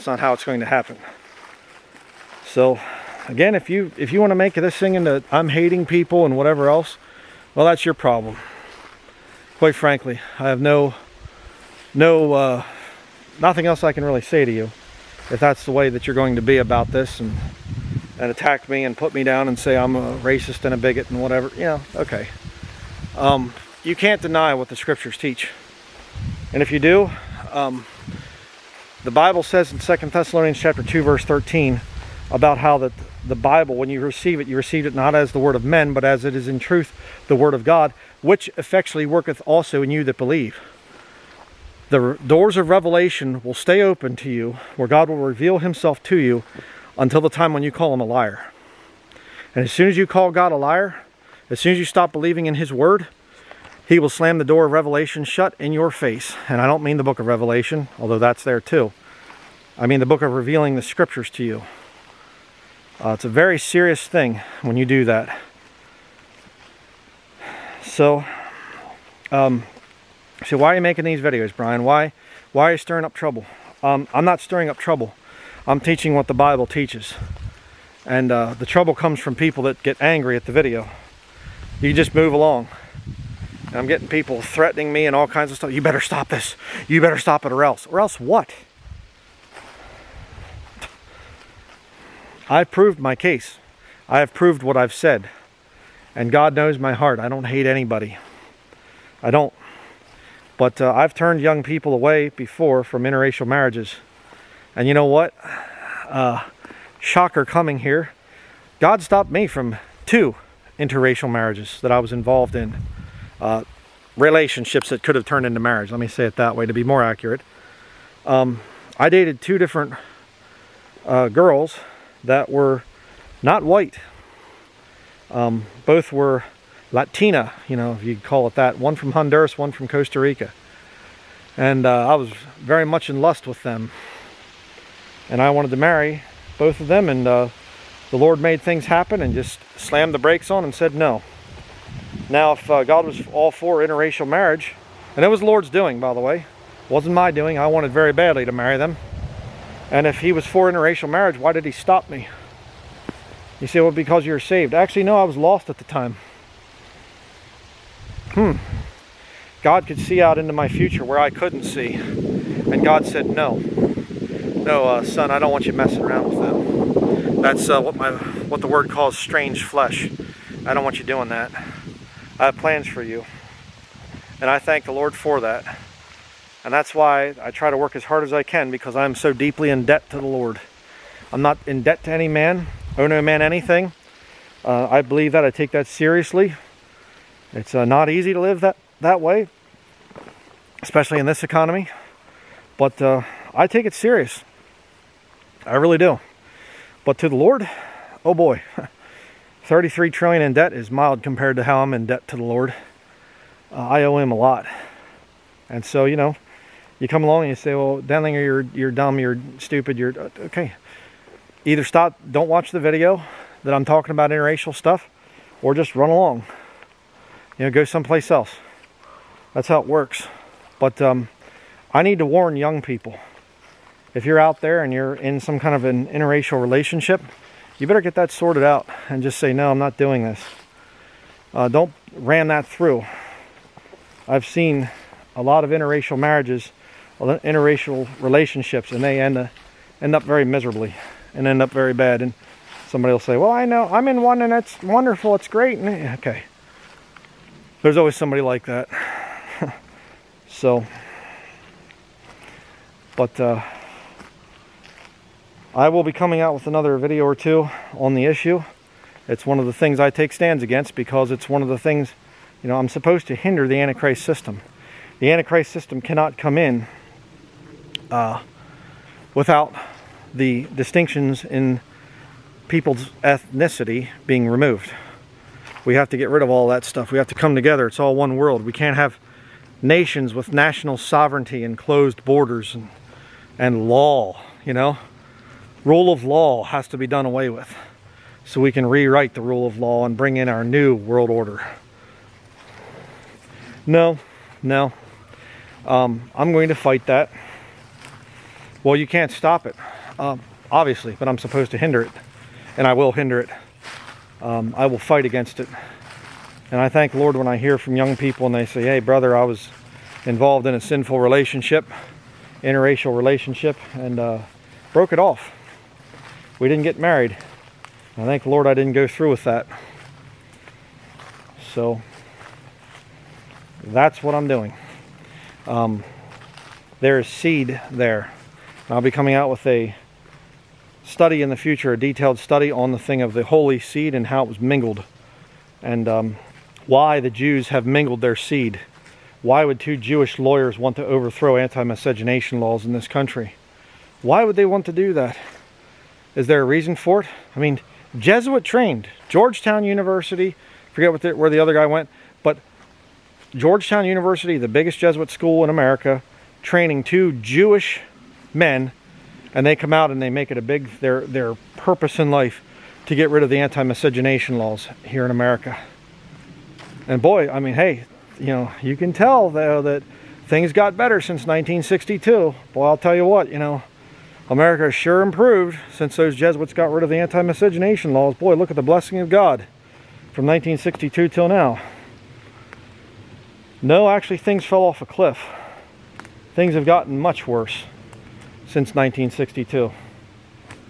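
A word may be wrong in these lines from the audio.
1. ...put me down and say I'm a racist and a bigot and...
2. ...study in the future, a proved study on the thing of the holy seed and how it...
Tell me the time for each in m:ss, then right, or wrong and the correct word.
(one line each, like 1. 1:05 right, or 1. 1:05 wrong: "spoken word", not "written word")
1. 0:18 right
2. 5:31 wrong: "detailed", not "proved".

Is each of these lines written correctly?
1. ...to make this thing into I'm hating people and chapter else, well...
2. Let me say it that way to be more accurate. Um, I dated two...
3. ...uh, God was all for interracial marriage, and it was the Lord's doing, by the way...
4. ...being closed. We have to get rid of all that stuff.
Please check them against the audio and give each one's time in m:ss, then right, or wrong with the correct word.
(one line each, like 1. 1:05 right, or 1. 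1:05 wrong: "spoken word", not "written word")
1. 0:04 wrong: "whatever", not "chapter"
2. 1:55 right
3. 2:22 right
4. 4:34 wrong: "removed", not "closed".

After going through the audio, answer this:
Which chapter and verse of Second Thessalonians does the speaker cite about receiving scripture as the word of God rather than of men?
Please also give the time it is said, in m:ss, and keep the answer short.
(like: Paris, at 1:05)
Chapter 2, verse 13, at 0:30.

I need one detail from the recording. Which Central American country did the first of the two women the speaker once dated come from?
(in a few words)
Honduras.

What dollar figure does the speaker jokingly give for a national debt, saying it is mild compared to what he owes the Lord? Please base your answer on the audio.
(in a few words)
33 trillion.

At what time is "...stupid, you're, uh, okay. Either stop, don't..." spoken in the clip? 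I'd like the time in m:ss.
3:29.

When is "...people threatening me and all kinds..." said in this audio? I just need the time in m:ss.
1:24.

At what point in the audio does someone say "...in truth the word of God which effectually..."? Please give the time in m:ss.
0:36.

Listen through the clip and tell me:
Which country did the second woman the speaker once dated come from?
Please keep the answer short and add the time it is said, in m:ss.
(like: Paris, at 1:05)
Costa Rica, at 2:09.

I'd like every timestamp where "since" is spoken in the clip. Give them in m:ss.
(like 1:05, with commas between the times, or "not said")
6:11, 6:15, 6:28.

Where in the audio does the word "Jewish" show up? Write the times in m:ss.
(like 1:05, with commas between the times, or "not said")
5:39, 5:57.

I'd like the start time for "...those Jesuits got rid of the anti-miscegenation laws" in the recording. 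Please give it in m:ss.
6:16.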